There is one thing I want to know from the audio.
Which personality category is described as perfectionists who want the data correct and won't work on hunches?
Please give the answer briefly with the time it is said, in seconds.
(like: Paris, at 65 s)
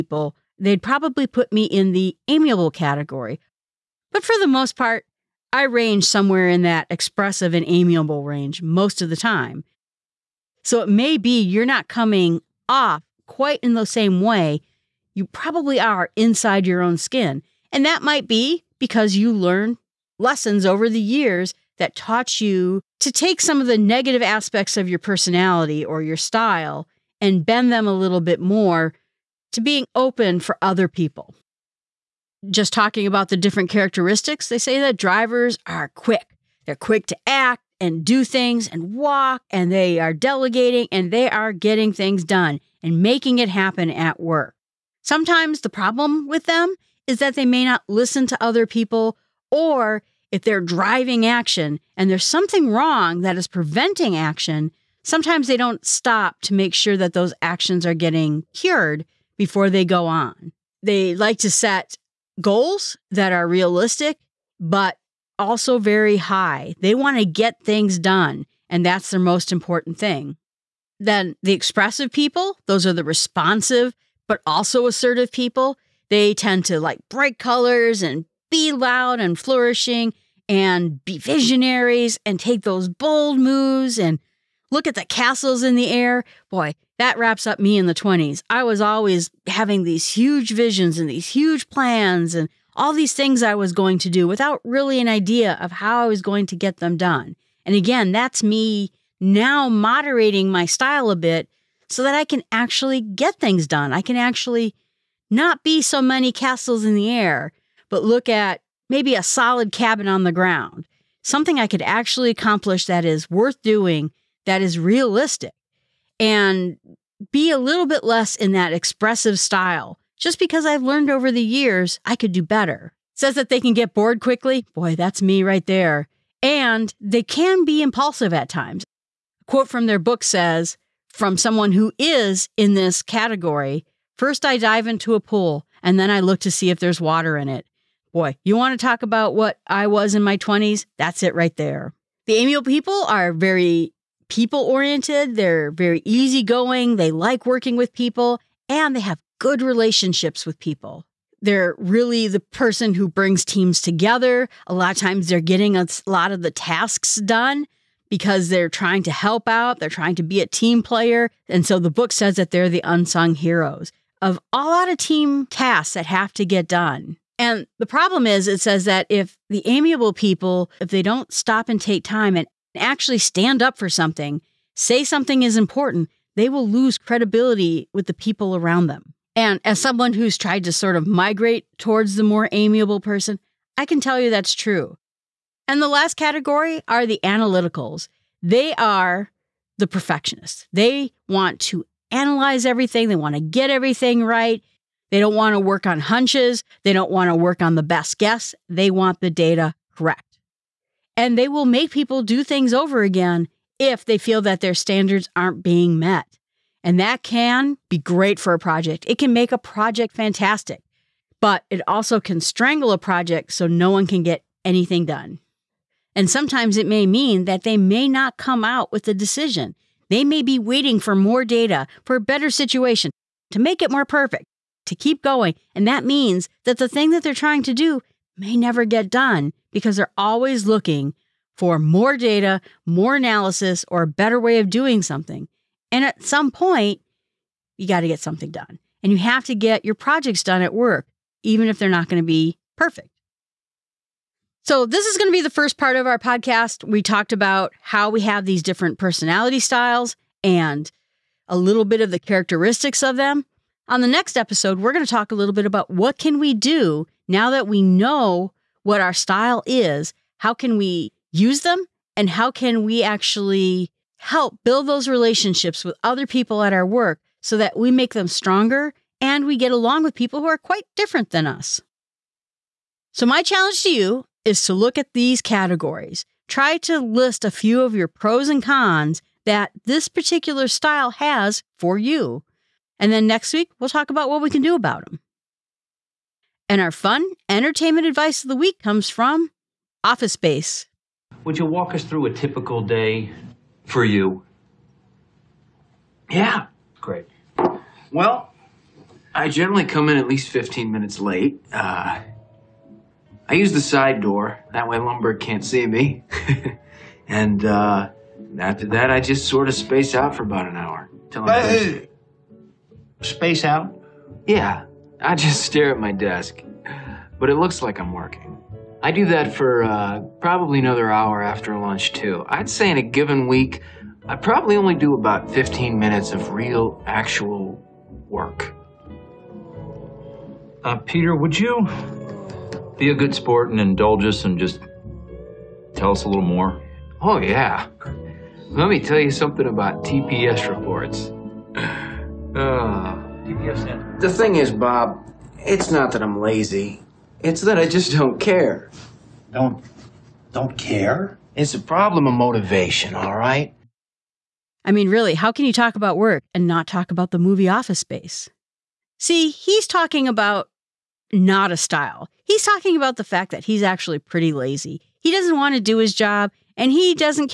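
Analyticals, at 187 s.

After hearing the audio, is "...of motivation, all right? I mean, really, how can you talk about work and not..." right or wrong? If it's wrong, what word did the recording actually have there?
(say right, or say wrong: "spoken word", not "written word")
right.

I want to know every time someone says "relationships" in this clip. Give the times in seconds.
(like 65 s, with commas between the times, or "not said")
149 s, 265 s.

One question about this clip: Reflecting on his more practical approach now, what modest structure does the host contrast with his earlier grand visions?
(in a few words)
A solid cabin.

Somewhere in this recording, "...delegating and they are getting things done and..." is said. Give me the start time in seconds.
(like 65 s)
40 s.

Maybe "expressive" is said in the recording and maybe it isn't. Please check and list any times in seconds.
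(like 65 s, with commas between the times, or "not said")
6 s, 71 s, 118 s.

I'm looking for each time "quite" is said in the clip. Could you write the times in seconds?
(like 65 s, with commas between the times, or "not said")
13 s, 270 s.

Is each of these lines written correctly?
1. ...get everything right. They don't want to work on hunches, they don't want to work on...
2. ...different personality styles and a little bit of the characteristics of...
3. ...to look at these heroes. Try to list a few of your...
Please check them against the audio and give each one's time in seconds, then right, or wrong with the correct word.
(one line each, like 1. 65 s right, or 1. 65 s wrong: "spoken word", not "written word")
1. 193 s right
2. 248 s right
3. 274 s wrong: "categories", not "heroes".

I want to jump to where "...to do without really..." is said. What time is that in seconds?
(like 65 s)
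93 s.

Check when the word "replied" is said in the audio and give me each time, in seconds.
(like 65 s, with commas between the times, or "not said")
not said.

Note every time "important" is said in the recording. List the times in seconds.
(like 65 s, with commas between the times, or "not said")
69 s, 175 s.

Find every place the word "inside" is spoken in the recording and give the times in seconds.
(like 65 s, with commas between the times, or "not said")
16 s.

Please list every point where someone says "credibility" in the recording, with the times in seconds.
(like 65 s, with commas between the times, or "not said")
176 s.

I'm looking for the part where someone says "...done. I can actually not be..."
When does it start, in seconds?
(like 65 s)
103 s.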